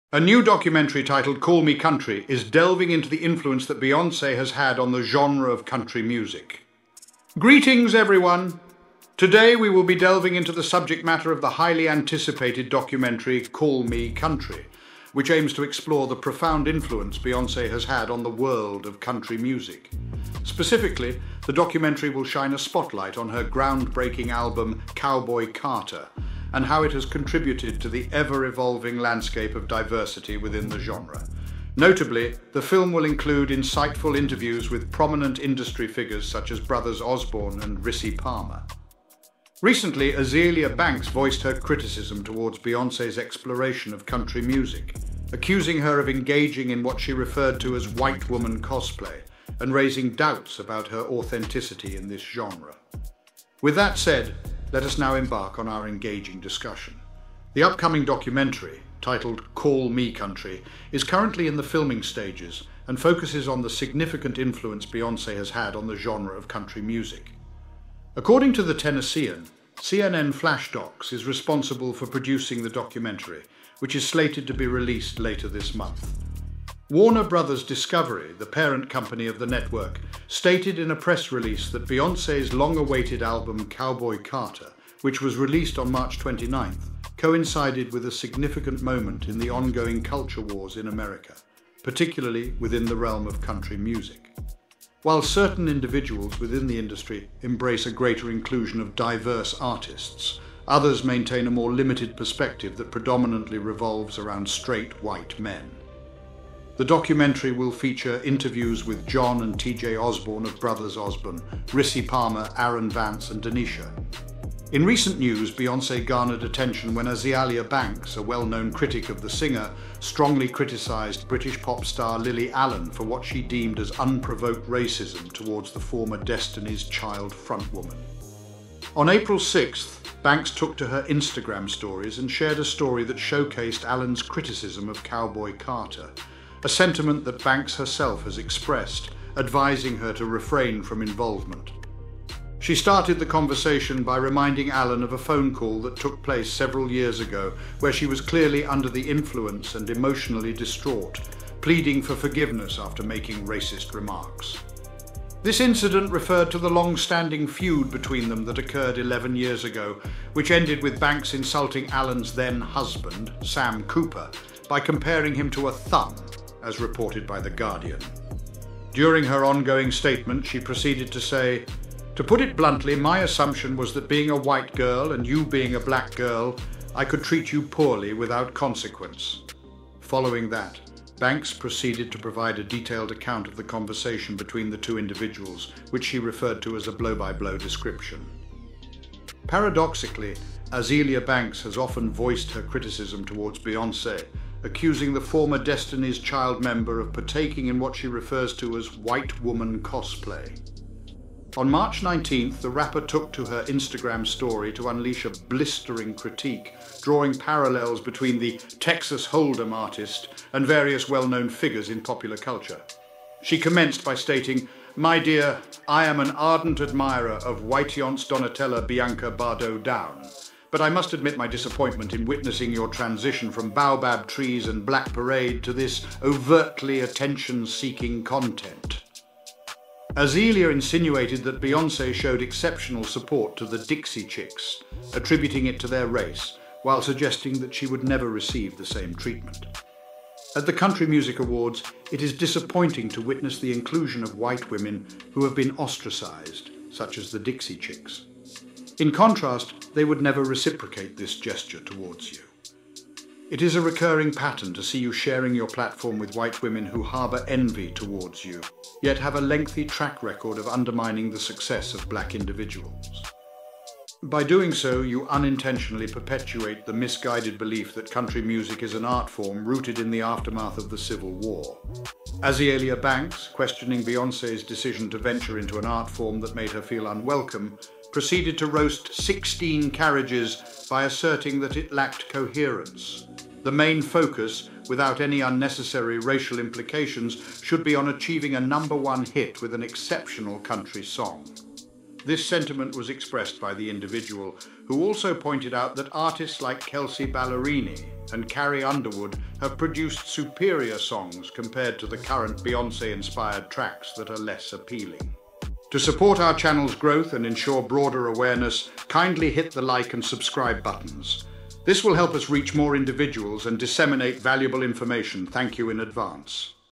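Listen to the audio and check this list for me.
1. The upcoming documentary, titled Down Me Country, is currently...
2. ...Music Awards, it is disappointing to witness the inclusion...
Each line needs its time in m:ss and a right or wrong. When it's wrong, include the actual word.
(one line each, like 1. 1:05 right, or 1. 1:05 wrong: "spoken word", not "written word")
1. 0:57 wrong: "Call", not "Down"
2. 4:01 right.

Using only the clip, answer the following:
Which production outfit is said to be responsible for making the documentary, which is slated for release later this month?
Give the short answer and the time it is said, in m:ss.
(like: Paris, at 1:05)
CNN Flash Docs, at 1:09.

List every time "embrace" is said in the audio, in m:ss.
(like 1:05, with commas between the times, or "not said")
1:37.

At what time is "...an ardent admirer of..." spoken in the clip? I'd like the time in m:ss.
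3:36.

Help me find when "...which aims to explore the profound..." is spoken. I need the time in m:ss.
0:15.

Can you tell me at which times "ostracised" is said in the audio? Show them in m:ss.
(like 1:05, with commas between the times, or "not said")
4:05.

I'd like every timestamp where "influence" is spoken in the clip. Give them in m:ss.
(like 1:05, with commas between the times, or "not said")
0:03, 0:16, 1:04, 2:29.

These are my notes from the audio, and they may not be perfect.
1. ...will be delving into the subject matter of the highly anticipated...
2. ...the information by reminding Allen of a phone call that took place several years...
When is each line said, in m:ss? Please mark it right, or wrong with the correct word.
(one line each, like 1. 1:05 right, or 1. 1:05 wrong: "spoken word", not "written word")
1. 0:09 right
2. 2:23 wrong: "conversation", not "information".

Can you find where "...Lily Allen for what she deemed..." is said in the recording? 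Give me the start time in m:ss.
2:02.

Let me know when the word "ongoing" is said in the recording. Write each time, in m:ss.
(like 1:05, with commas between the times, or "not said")
1:29, 2:49.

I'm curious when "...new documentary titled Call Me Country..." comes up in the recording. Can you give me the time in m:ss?
0:00.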